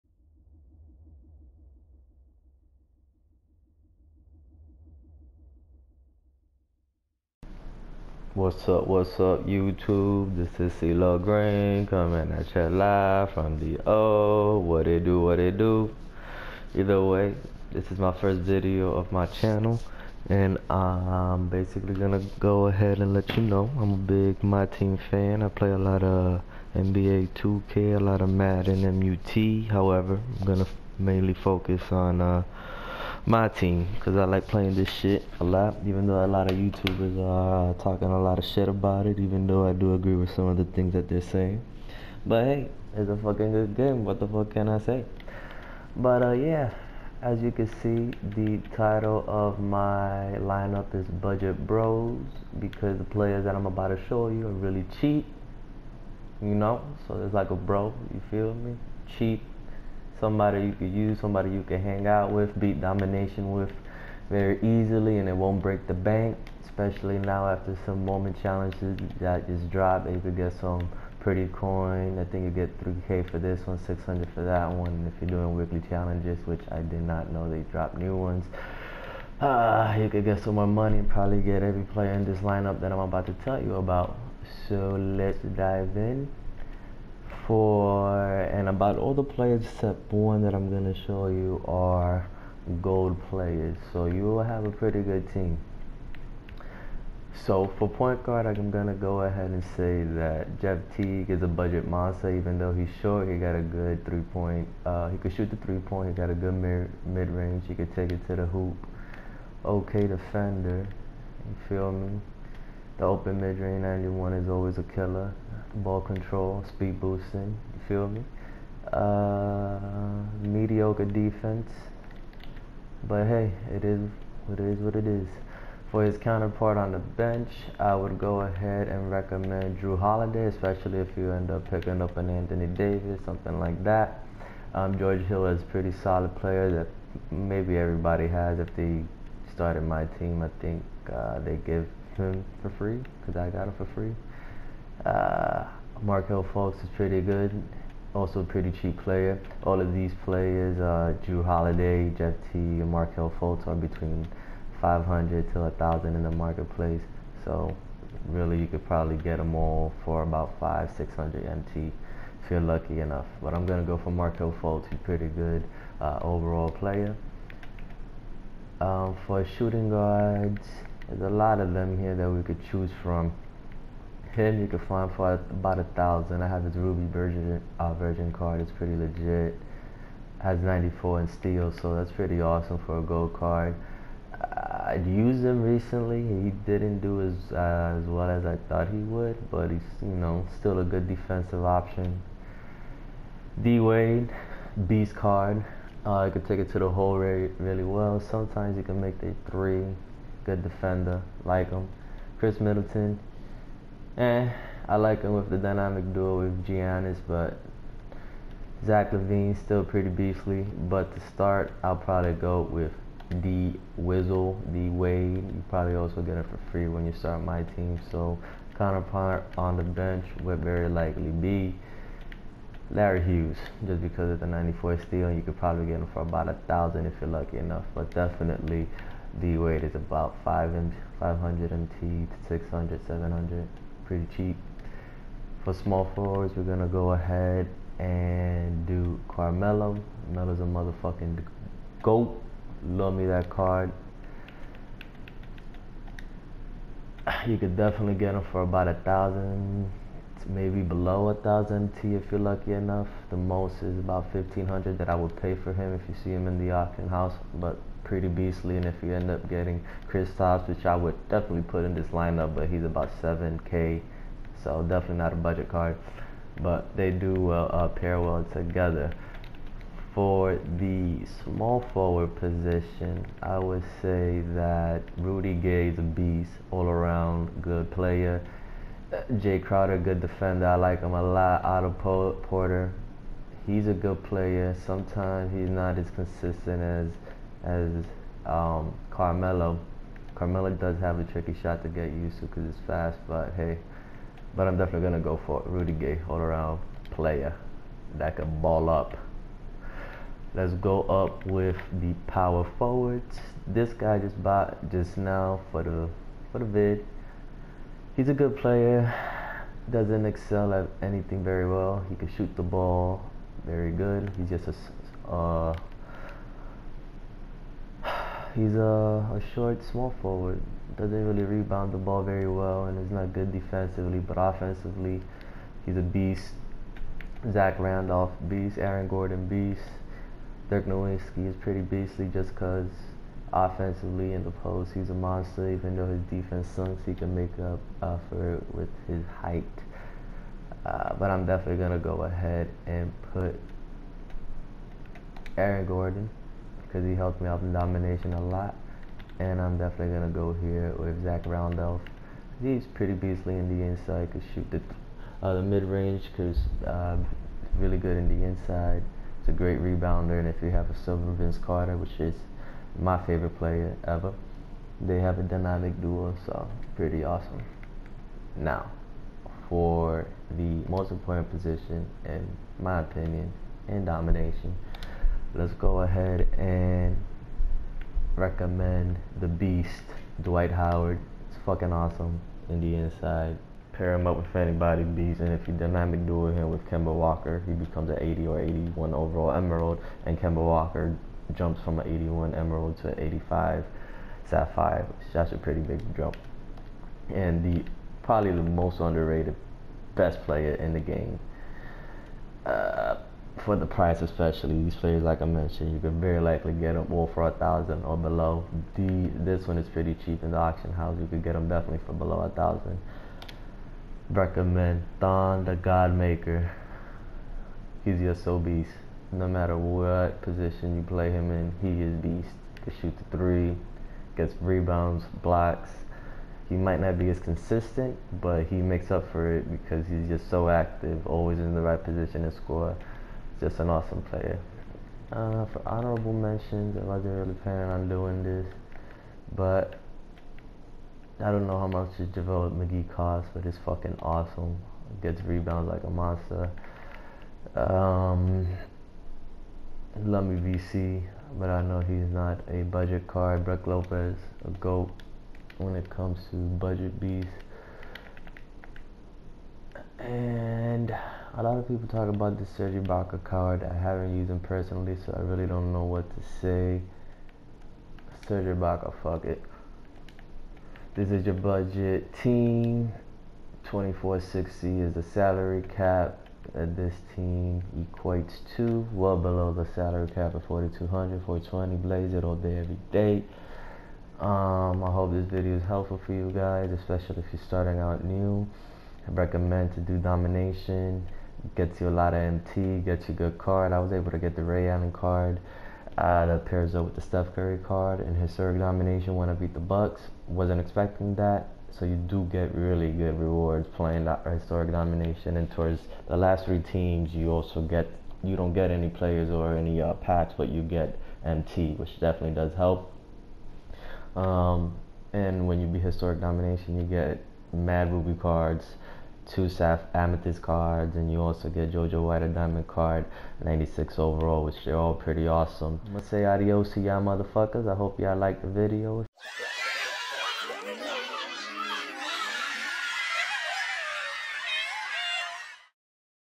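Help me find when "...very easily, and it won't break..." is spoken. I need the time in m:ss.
1:04.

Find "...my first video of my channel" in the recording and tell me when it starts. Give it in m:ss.
0:17.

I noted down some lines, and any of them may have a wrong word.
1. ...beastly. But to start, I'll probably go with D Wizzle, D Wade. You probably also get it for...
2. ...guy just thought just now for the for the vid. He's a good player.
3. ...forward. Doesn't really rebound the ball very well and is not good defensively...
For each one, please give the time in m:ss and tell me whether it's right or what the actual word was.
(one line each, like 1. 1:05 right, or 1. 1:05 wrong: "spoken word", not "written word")
1. 3:30 right
2. 5:03 wrong: "bought", not "thought"
3. 5:20 right.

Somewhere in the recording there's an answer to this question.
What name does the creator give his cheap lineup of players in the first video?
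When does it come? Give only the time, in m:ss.
0:51.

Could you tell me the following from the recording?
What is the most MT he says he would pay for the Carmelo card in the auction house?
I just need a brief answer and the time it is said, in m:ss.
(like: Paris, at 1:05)
1500, at 4:14.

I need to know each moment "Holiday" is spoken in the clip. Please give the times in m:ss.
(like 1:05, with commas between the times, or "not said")
2:09, 2:31.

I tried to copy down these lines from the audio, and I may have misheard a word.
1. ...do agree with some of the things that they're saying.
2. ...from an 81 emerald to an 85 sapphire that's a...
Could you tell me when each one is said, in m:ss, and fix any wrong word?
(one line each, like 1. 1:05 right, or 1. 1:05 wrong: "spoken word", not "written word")
1. 0:39 right
2. 6:31 right.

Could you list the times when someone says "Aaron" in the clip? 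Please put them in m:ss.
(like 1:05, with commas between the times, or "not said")
5:28, 5:45.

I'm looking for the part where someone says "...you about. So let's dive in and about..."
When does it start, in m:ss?
1:23.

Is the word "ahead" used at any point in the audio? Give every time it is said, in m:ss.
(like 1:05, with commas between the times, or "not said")
0:22, 1:39, 2:08, 3:57, 5:42, 6:16.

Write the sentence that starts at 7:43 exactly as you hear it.
I haven't used him personally, so I really don't know what to say.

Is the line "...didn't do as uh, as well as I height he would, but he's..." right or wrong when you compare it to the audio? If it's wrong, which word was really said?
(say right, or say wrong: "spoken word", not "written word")
wrong: "thought", not "height".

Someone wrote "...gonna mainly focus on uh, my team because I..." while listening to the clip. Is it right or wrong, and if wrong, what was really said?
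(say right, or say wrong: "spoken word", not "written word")
right.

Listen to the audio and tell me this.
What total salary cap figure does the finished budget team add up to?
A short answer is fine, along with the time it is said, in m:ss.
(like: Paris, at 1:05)
2460, at 7:53.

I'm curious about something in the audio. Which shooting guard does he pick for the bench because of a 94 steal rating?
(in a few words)
Larry Hughes.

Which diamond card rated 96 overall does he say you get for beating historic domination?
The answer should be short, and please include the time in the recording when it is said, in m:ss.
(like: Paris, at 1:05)
JoJo White, at 8:41.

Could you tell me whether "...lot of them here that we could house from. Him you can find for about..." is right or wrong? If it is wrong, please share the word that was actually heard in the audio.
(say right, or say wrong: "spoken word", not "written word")
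wrong: "choose", not "house".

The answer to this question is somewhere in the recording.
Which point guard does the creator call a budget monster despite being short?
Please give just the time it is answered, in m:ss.
1:40.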